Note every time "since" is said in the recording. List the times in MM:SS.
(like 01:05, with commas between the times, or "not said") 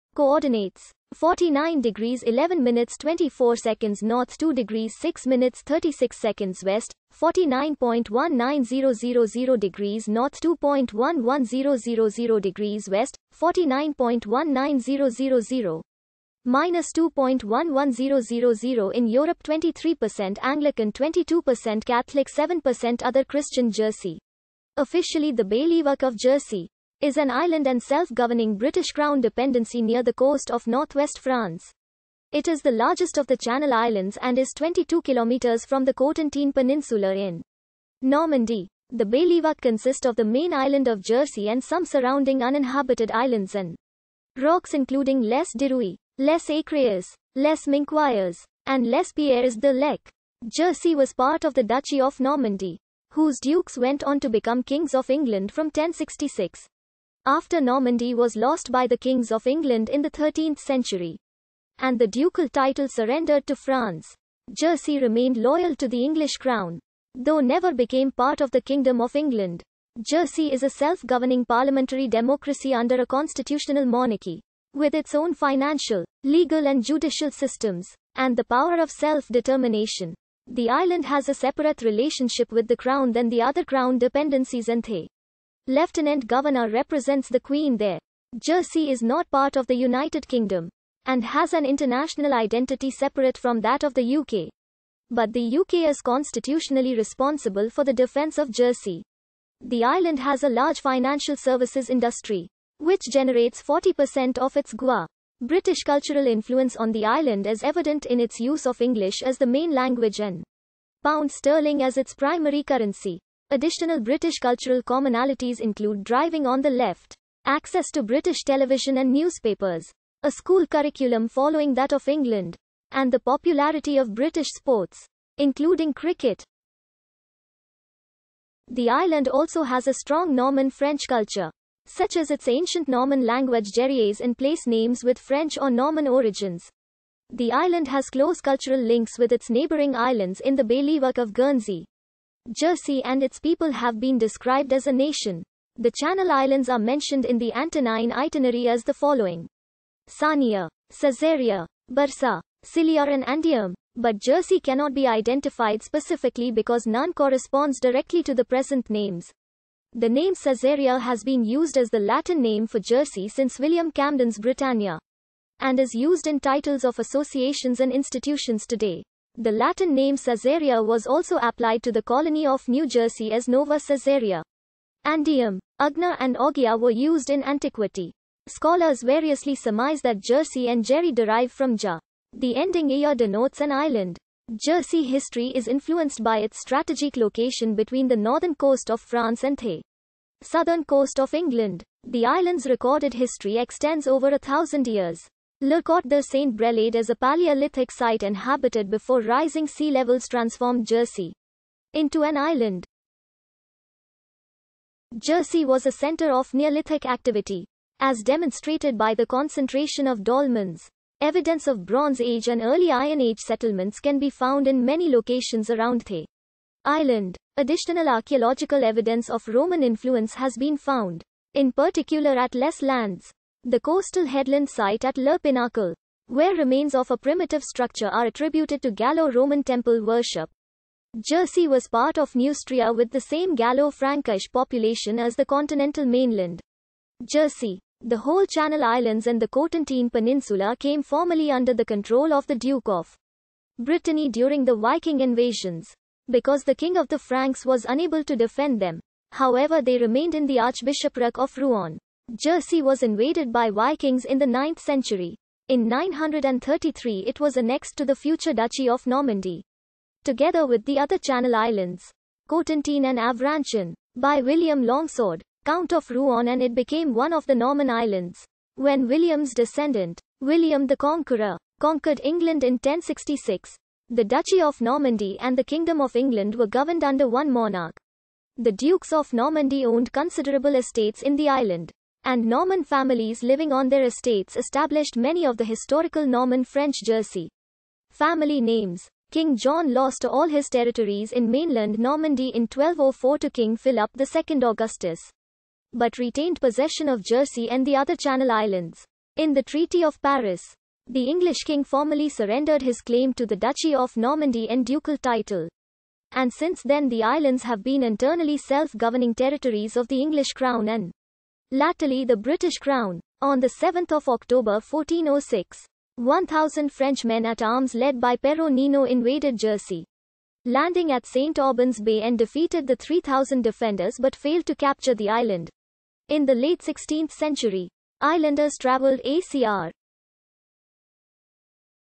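02:43, 05:06.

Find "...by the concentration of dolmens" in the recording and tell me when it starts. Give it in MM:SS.
03:28.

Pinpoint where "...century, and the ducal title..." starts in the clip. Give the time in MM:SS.
01:00.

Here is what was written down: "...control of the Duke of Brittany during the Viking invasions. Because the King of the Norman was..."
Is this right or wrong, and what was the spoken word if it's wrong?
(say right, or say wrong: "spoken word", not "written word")
wrong: "Franks", not "Norman".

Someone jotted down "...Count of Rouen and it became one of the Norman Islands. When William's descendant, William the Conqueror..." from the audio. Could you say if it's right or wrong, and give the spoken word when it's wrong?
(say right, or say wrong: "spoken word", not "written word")
right.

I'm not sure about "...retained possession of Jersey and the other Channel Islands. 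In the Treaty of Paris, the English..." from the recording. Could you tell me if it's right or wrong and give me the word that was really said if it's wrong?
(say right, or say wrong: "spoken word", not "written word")
right.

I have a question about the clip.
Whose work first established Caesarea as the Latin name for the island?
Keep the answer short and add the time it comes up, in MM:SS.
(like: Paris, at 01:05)
William Camden, at 02:43.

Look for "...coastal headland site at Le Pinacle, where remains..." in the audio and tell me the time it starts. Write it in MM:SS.
03:43.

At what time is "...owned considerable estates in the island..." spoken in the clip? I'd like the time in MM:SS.
04:39.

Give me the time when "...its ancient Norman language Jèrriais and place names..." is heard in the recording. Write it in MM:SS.
02:12.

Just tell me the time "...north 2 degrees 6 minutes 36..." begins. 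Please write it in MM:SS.
00:04.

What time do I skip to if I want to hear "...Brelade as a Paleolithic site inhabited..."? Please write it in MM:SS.
03:16.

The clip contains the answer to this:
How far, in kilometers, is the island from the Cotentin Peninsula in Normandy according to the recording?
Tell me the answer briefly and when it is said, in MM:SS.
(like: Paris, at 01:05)
22 kilometers, at 00:34.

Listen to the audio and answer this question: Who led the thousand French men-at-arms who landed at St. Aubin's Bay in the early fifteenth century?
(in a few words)
Pero Nino.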